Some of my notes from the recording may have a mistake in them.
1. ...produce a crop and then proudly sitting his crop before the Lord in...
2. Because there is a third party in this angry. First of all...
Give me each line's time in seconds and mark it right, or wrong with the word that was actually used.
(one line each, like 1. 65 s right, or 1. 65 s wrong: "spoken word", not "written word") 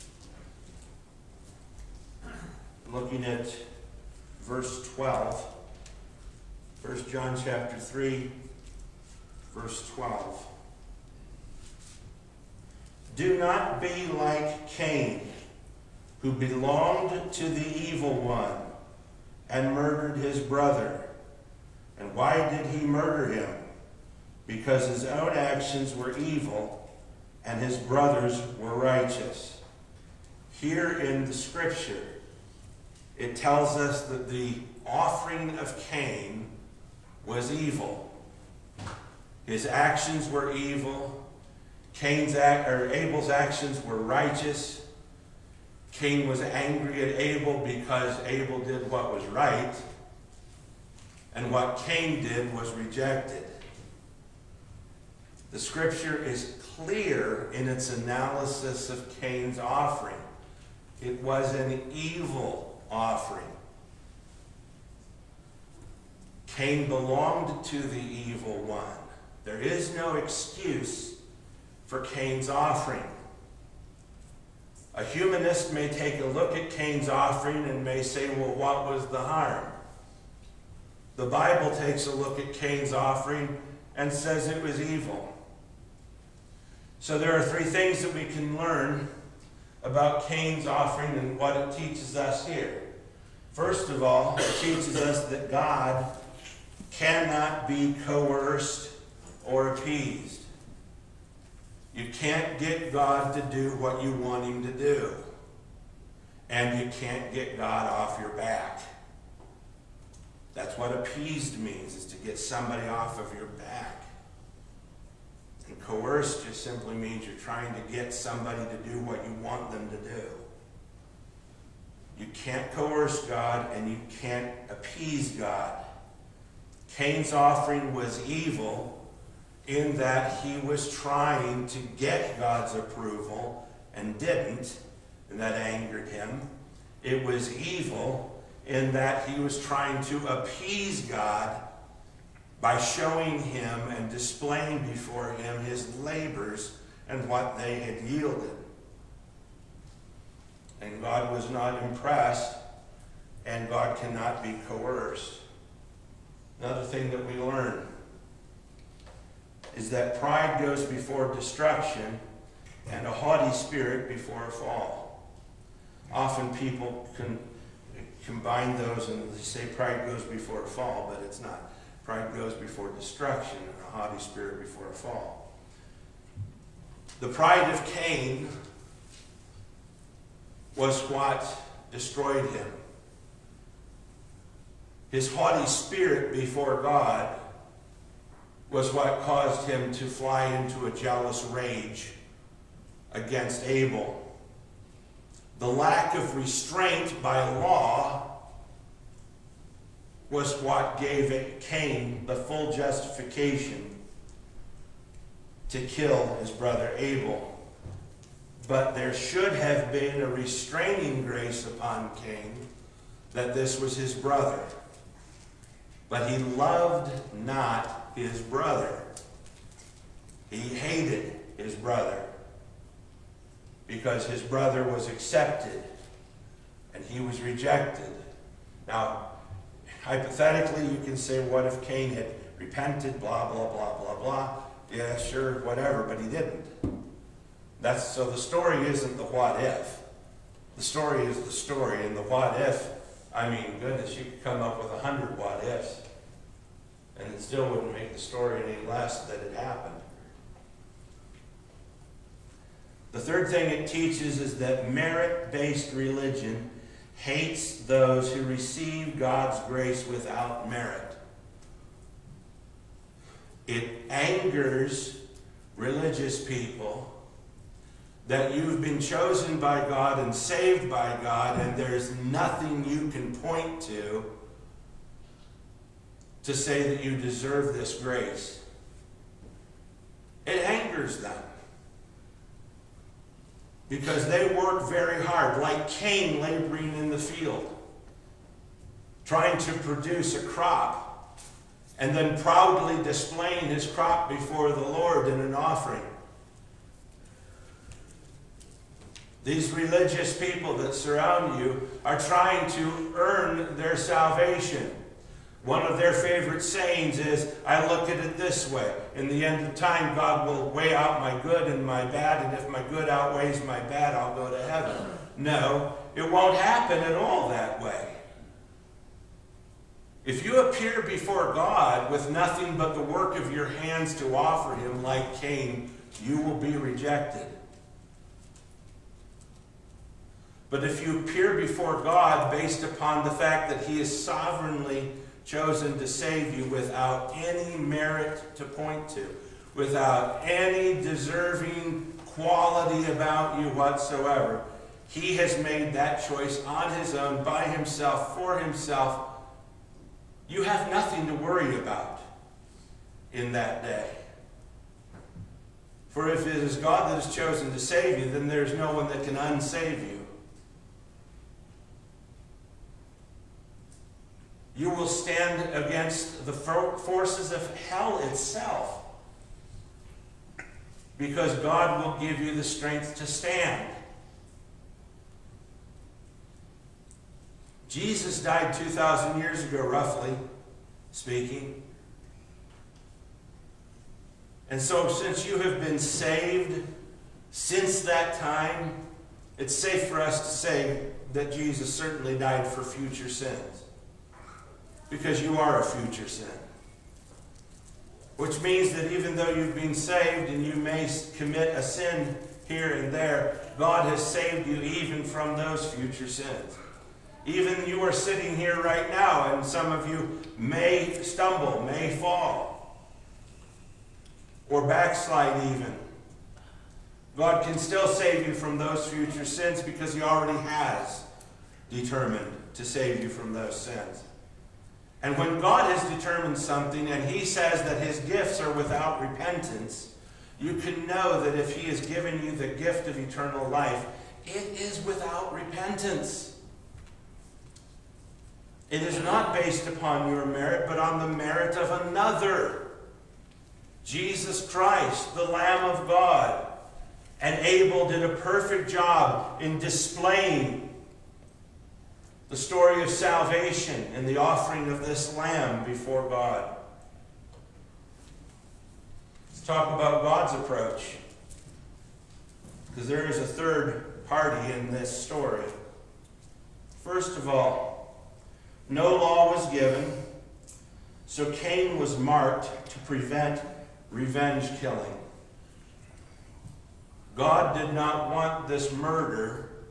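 1. 289 s wrong: "displaying", not "sitting"
2. 462 s wrong: "story", not "angry".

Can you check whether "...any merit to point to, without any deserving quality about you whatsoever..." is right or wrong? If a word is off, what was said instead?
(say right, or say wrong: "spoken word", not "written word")
right.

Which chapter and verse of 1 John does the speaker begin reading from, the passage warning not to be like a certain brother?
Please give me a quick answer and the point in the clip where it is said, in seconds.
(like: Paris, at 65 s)
Chapter 3, verse 12, at 7 s.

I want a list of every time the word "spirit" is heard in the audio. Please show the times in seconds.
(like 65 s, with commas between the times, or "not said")
163 s, 174 s, 185 s.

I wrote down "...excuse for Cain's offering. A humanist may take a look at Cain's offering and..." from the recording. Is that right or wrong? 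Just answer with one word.
right.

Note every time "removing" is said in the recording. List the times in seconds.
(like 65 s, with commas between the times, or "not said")
not said.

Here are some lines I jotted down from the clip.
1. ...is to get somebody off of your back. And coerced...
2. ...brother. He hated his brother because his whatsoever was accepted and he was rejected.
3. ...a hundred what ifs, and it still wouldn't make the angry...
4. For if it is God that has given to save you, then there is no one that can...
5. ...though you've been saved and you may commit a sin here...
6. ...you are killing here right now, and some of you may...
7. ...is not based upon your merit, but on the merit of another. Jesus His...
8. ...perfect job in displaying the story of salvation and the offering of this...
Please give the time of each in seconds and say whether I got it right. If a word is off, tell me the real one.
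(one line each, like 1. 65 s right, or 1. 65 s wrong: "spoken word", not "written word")
1. 111 s right
2. 218 s wrong: "brother", not "whatsoever"
3. 244 s wrong: "story", not "angry"
4. 356 s wrong: "chosen", not "given"
5. 399 s right
6. 407 s wrong: "sitting", not "killing"
7. 439 s wrong: "Christ", not "His"
8. 448 s right.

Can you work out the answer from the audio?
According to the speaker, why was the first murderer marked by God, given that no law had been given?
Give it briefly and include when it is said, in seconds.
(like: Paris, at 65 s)
To prevent revenge killing, at 472 s.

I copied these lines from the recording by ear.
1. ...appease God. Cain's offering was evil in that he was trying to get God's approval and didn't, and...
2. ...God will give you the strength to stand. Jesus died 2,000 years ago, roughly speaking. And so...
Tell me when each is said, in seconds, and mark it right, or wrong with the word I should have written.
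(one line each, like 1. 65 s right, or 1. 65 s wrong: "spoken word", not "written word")
1. 124 s right
2. 371 s right.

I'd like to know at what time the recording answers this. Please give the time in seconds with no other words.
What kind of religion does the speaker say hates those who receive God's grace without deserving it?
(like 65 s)
254 s.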